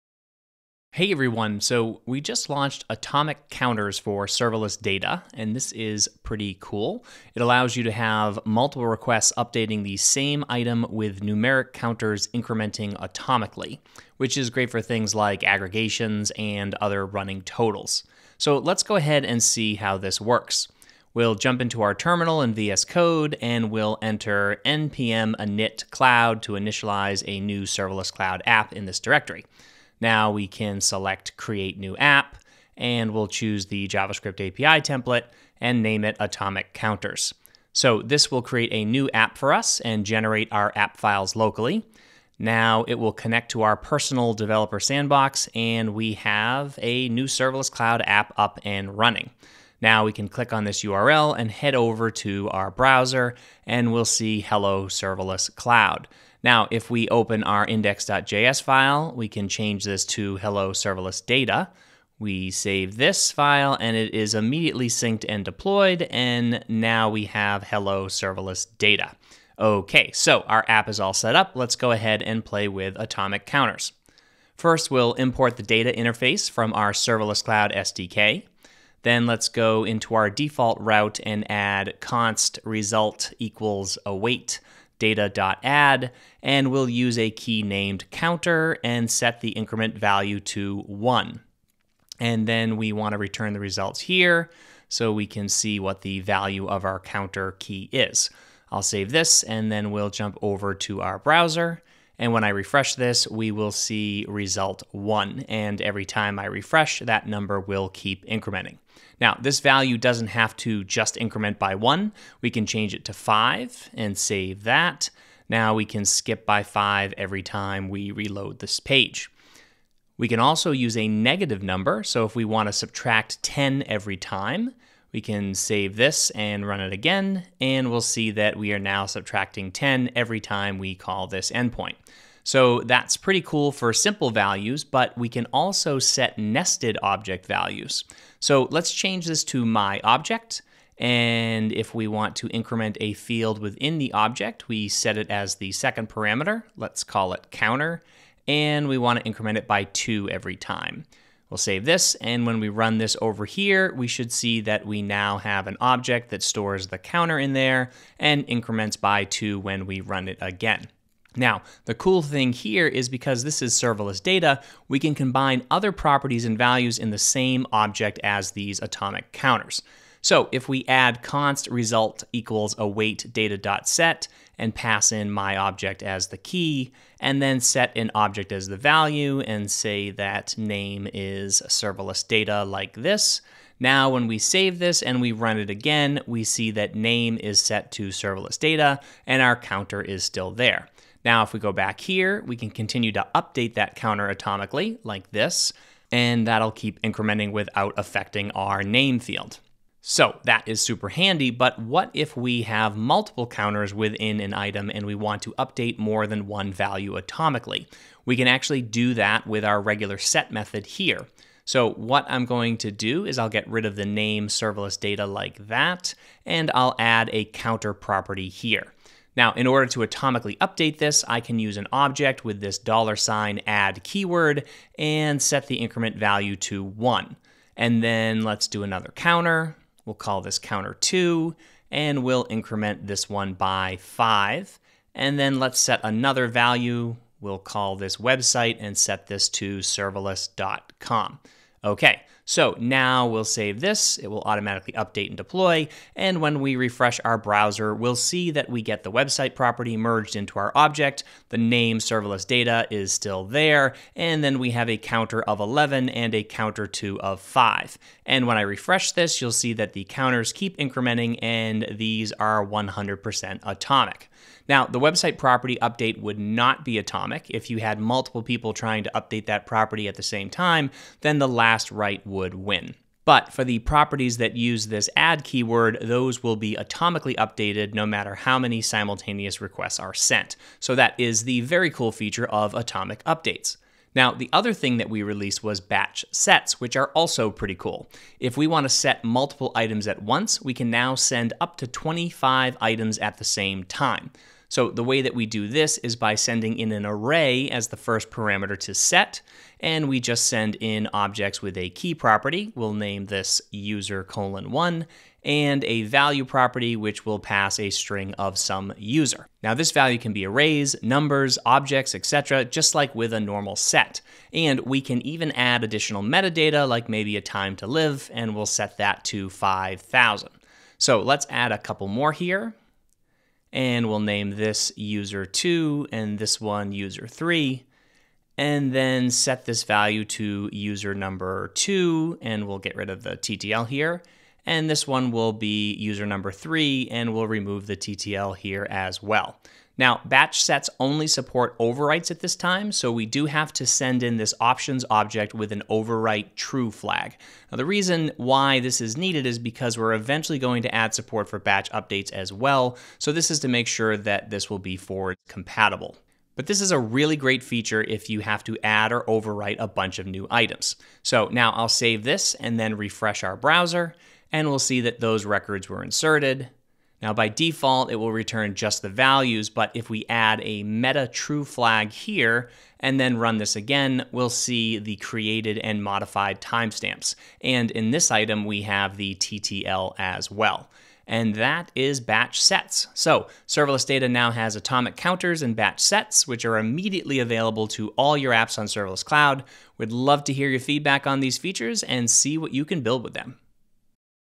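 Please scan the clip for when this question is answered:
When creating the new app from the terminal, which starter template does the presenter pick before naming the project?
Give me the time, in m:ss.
0:33.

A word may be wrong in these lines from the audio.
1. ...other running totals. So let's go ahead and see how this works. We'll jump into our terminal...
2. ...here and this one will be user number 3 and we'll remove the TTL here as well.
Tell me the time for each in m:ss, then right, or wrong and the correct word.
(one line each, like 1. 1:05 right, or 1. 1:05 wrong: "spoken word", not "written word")
1. 0:16 right
2. 5:33 right.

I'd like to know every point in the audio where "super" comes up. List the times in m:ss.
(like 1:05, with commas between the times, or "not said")
3:20.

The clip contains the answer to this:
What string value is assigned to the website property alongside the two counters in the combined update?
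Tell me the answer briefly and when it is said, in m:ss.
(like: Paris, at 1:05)
serverless.com, at 3:59.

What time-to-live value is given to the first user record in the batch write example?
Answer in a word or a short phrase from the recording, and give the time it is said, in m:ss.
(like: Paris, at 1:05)
5000, at 5:19.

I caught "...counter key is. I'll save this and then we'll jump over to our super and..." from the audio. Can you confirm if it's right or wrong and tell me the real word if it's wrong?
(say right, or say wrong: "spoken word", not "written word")
wrong: "browser", not "super".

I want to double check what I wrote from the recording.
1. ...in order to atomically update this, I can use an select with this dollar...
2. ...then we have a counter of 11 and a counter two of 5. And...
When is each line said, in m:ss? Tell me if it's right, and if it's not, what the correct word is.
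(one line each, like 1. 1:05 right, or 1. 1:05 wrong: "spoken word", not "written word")
1. 3:39 wrong: "object", not "select"
2. 4:14 right.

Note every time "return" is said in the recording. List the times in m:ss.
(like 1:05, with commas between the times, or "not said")
1:33, 6:08.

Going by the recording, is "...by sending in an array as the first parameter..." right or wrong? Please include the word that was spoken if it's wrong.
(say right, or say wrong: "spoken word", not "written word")
right.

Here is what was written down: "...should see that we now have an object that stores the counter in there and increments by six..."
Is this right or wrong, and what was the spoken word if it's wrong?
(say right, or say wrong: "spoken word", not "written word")
wrong: "two", not "six".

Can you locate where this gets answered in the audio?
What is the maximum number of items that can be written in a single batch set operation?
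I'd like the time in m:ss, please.
4:51.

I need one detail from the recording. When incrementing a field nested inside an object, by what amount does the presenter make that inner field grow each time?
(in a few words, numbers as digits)
2.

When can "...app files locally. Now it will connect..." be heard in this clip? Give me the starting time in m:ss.
0:40.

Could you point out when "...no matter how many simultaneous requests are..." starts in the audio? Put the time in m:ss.
4:37.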